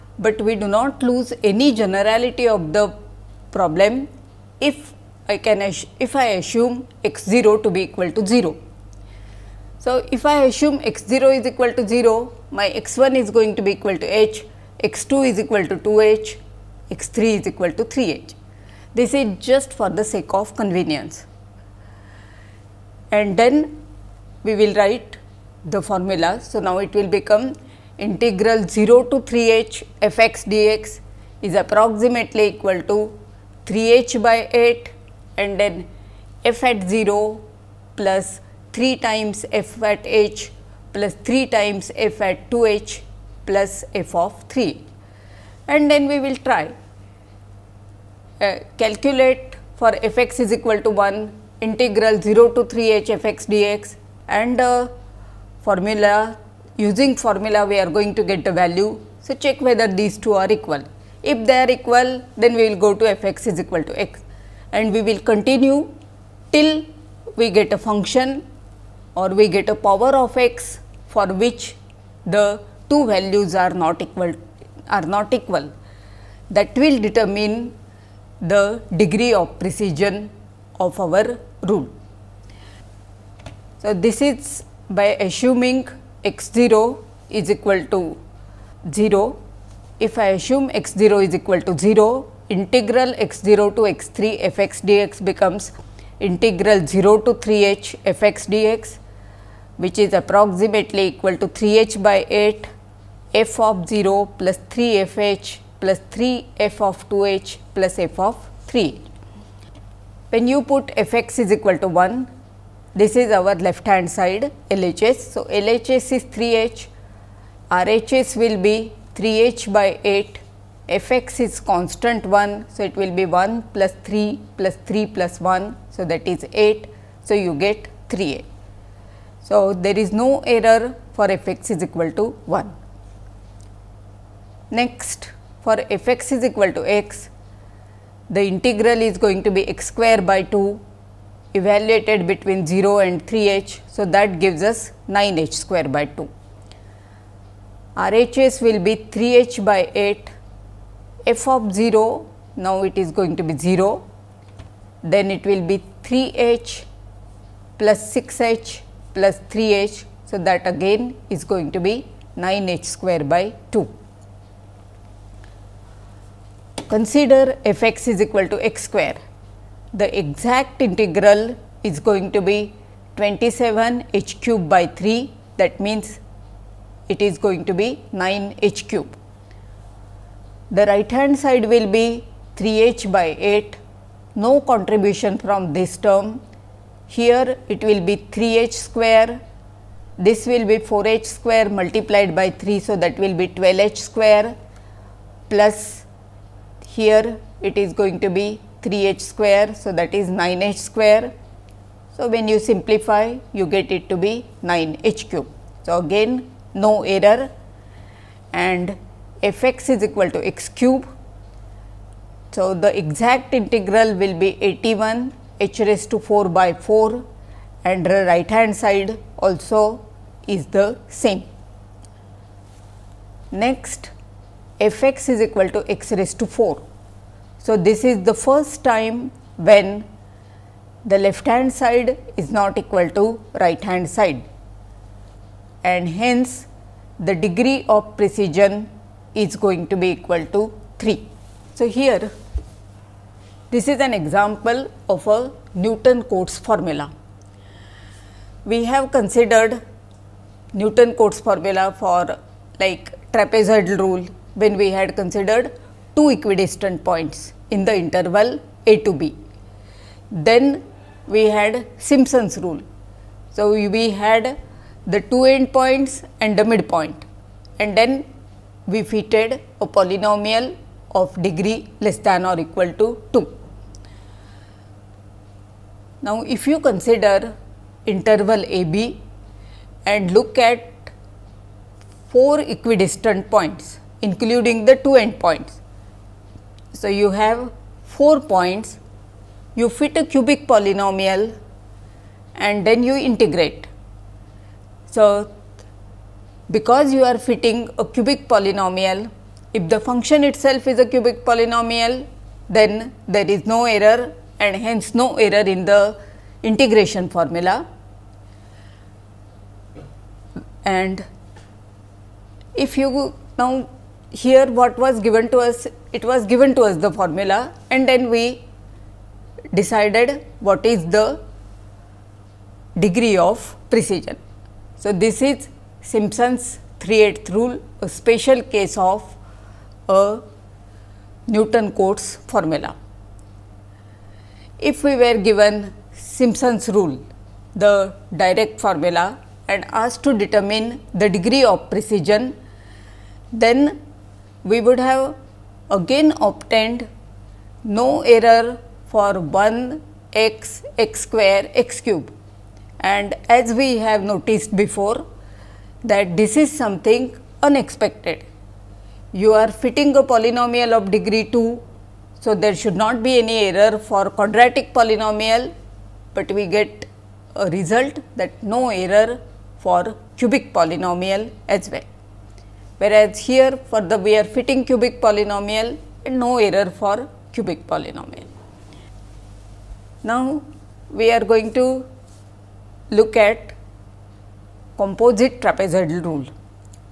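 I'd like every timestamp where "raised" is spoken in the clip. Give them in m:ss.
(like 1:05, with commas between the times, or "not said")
3:35, 3:46.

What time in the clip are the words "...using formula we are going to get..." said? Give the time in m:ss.
0:56.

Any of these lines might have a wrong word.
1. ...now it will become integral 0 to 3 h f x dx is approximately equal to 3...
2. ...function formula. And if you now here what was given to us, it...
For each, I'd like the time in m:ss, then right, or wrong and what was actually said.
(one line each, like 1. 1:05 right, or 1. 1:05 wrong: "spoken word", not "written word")
1. 0:26 right
2. 5:06 wrong: "integration", not "function".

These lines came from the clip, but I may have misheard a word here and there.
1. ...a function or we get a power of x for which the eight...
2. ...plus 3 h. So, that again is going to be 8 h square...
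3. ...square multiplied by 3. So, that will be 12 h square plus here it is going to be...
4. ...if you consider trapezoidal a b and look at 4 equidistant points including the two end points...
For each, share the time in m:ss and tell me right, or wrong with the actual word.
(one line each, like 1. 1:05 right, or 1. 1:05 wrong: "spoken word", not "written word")
1. 1:07 wrong: "two", not "eight"
2. 2:39 wrong: "9", not "8"
3. 3:11 right
4. 4:36 wrong: "interval", not "trapezoidal".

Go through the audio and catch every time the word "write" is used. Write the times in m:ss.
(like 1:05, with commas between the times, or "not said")
0:24.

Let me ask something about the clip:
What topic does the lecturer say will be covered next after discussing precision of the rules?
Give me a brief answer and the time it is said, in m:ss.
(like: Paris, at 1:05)
composite trapezoidal rule, at 6:24.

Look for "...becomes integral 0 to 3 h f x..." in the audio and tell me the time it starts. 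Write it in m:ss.
1:35.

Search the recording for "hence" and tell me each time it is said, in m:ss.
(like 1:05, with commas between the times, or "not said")
3:56, 5:04.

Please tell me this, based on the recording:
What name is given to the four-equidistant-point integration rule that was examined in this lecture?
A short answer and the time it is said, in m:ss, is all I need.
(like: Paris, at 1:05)
Simpson's 3/8th rule, at 5:26.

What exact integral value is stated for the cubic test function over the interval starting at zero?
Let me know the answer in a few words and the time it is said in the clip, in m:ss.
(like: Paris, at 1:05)
81h⁴/4, at 3:34.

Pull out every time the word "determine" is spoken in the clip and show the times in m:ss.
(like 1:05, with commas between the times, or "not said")
1:17, 5:40.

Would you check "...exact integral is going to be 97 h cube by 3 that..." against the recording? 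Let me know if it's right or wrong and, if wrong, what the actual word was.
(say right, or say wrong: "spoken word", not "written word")
wrong: "27", not "97".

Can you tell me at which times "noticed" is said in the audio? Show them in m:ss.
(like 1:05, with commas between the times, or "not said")
5:54.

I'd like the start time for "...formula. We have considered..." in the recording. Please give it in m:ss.
4:06.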